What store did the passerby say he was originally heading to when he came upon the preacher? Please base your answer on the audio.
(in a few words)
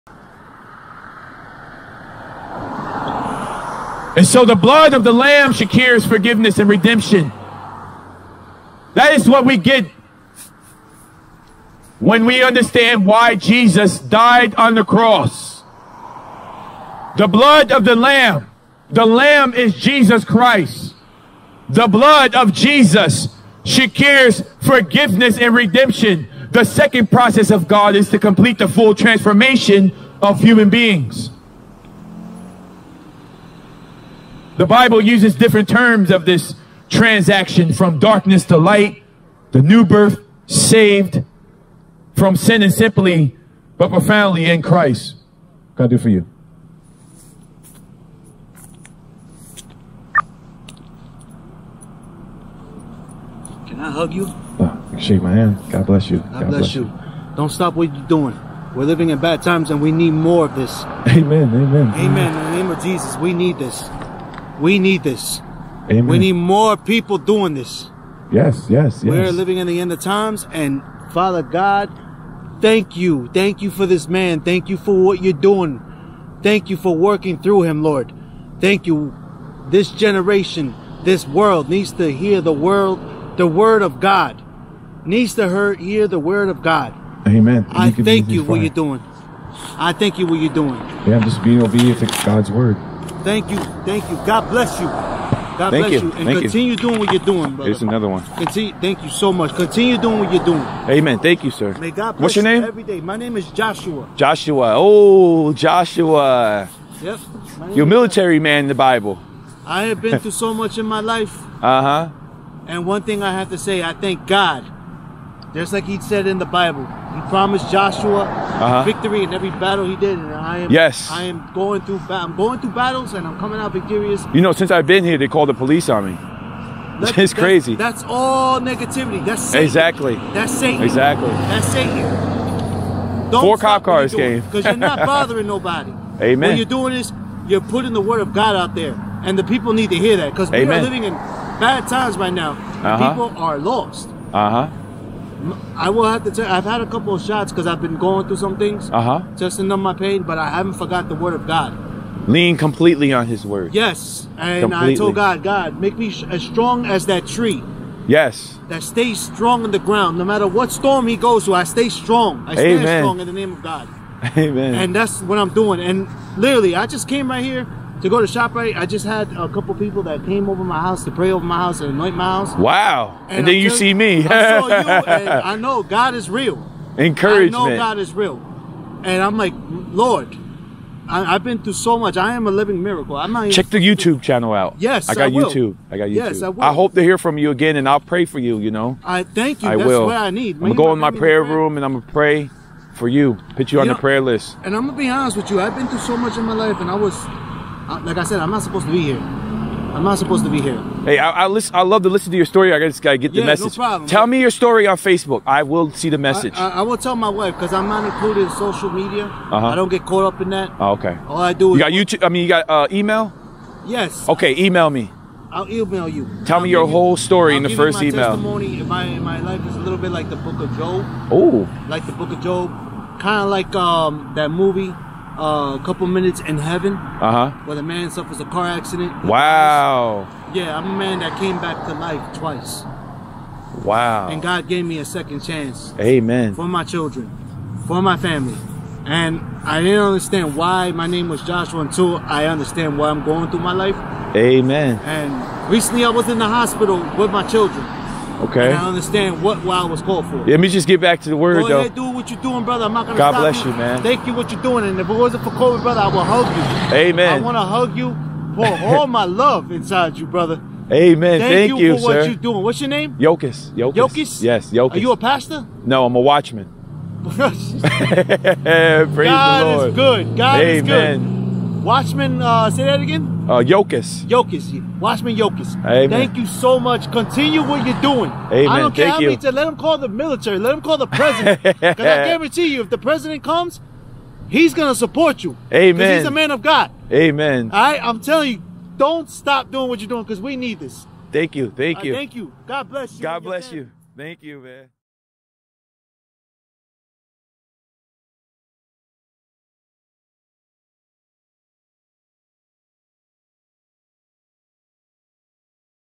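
ShopRite.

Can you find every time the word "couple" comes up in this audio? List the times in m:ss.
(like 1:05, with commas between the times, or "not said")
2:26, 2:49, 3:45.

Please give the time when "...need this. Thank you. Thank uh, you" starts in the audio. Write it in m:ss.
4:50.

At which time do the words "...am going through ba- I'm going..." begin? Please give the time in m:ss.
2:01.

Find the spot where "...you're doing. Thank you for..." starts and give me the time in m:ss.
1:15.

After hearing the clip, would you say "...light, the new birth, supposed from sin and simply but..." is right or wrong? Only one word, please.
wrong.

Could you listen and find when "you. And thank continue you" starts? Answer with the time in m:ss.
1:35.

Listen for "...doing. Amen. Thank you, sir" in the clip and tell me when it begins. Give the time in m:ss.
1:40.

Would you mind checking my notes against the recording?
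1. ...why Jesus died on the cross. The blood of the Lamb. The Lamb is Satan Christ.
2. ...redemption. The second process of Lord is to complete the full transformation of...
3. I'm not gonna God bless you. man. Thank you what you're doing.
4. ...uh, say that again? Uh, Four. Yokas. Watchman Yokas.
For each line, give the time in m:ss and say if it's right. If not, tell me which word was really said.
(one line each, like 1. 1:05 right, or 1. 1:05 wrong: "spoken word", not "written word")
1. 0:13 wrong: "Jesus", not "Satan"
2. 0:25 wrong: "God", not "Lord"
3. 4:12 right
4. 4:32 wrong: "Yokas", not "Four".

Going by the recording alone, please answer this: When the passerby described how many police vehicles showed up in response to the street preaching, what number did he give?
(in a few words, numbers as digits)
4.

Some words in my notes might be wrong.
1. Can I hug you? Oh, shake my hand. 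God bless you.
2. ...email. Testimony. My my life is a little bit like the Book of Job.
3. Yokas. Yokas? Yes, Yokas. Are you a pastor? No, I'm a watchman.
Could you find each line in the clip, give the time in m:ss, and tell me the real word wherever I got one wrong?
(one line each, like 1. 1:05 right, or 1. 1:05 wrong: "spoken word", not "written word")
1. 0:53 right
2. 3:38 right
3. 4:23 right.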